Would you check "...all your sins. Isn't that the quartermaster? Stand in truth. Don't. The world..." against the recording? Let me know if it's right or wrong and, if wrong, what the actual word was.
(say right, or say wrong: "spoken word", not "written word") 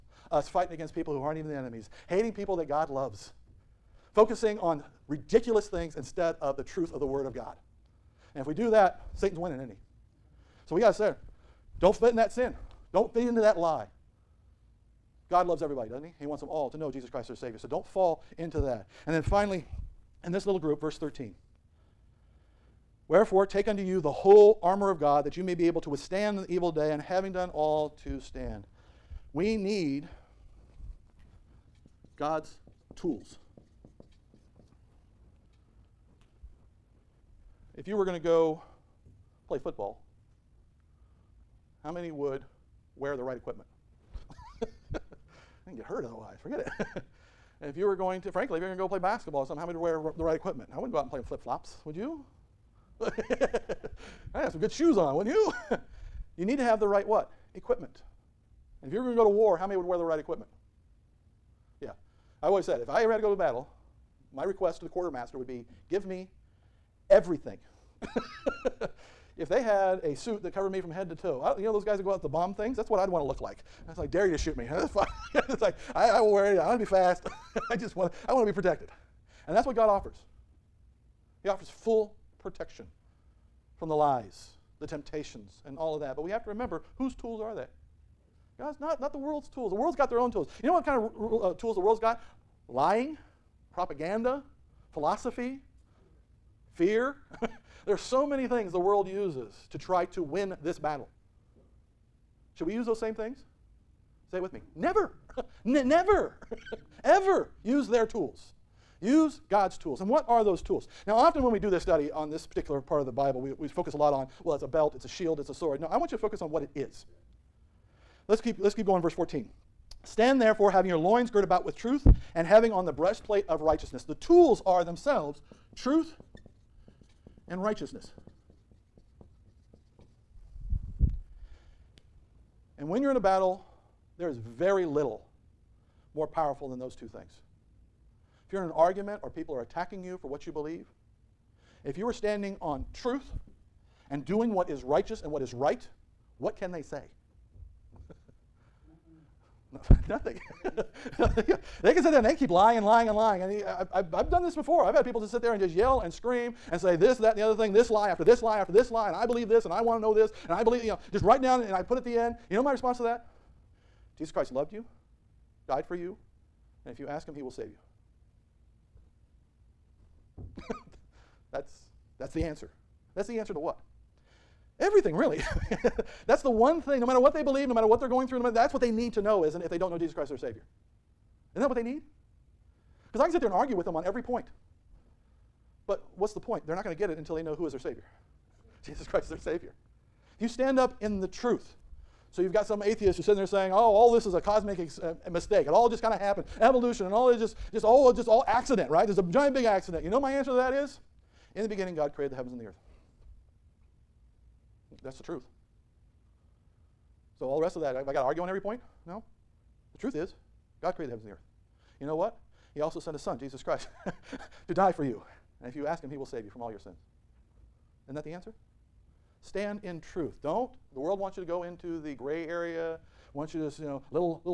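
wrong: "answer", not "quartermaster".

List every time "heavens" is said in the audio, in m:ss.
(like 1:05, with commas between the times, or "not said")
3:22, 3:31.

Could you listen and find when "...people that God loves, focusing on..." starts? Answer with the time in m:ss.
0:02.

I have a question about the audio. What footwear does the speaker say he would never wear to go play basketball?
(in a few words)
flip flops.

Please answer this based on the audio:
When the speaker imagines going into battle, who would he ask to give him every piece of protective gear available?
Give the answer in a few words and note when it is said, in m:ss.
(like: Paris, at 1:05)
the quartermaster, at 1:04.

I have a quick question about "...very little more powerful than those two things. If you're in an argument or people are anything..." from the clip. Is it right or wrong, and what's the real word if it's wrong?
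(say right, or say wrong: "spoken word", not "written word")
wrong: "attacking", not "anything".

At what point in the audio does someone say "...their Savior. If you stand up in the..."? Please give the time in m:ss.
3:09.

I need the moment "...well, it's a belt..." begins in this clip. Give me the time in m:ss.
1:54.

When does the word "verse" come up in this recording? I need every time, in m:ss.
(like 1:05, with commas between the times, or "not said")
0:20, 1:59.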